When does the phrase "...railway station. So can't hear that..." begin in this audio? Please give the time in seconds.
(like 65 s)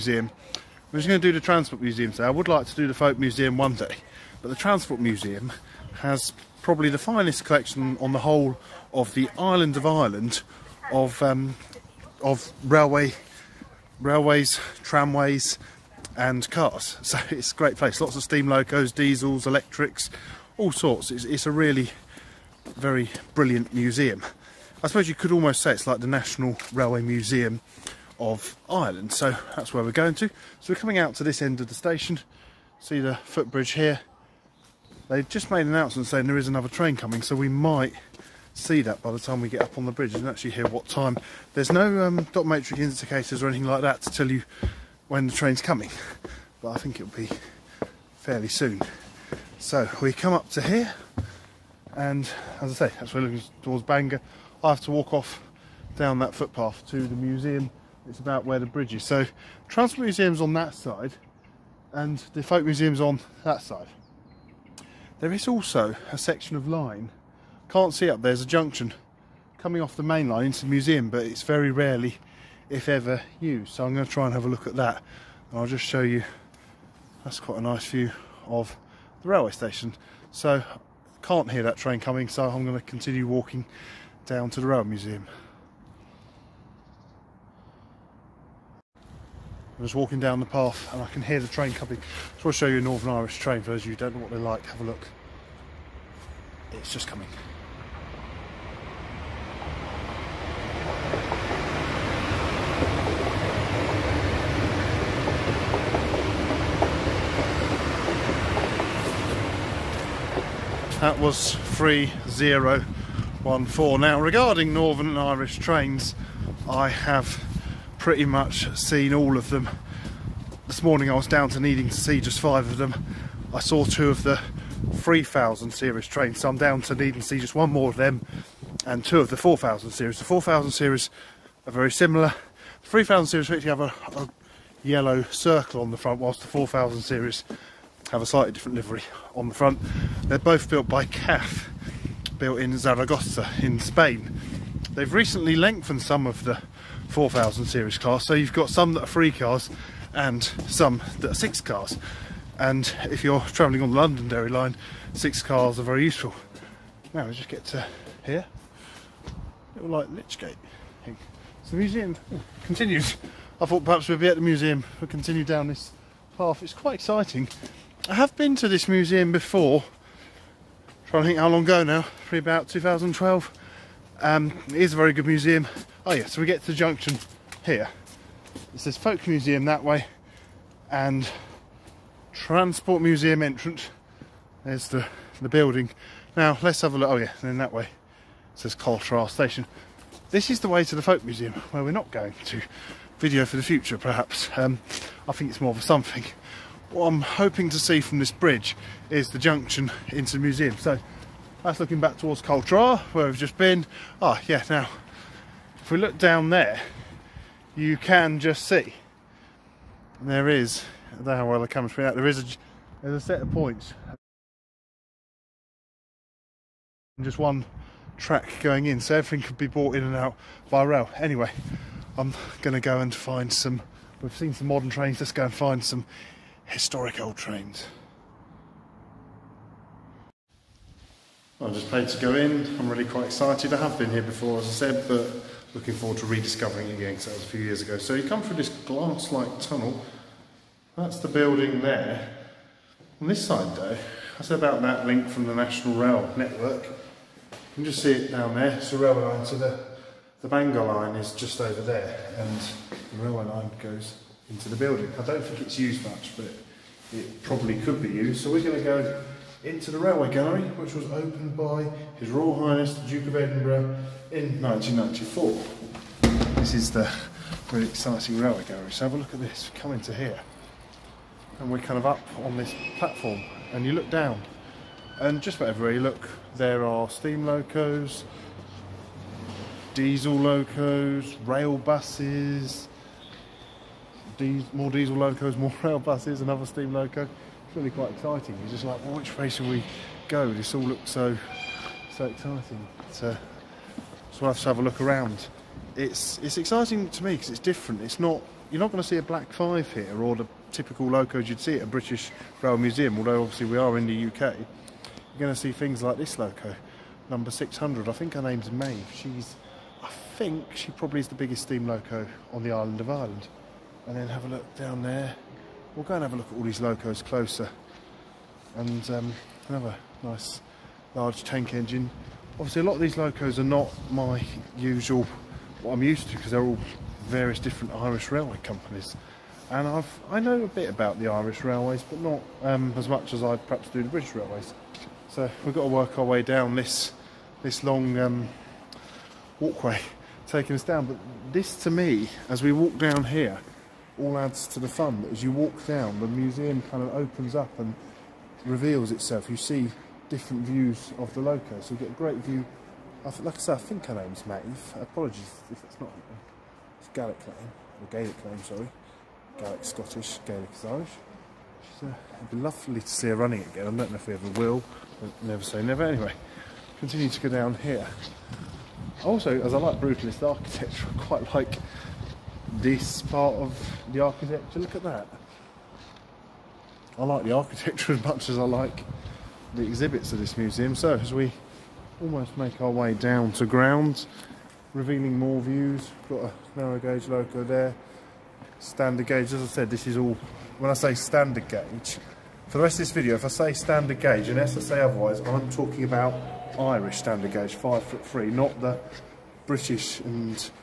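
79 s.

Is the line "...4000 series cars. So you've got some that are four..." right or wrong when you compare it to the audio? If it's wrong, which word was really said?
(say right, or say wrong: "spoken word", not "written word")
wrong: "three", not "four".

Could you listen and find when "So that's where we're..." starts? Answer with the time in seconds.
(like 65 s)
29 s.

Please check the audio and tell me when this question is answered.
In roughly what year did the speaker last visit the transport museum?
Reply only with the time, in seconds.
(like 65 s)
172 s.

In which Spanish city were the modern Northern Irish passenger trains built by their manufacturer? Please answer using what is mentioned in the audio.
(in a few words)
Zaragoza.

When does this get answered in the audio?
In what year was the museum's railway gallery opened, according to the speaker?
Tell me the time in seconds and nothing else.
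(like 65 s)
264 s.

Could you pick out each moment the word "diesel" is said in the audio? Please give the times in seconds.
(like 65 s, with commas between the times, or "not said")
18 s, 279 s, 284 s.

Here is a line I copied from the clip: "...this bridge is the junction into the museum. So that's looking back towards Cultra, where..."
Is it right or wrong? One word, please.
right.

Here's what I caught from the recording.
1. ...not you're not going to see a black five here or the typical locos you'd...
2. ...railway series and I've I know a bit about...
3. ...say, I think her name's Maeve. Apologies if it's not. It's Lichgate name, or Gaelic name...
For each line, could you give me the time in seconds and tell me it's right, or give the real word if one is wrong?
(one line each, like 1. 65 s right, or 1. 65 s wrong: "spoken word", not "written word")
1. 298 s right
2. 328 s wrong: "companies", not "series"
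3. 353 s wrong: "Gaelic", not "Lichgate".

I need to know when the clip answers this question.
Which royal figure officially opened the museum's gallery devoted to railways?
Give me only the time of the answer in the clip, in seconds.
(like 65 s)
263 s.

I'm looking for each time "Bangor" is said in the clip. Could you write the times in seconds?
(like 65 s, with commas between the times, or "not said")
53 s, 250 s.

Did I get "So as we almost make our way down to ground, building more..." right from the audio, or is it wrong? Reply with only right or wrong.
wrong.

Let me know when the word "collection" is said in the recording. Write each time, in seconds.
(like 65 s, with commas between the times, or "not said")
7 s.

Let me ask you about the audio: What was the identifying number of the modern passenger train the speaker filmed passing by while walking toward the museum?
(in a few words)
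3014.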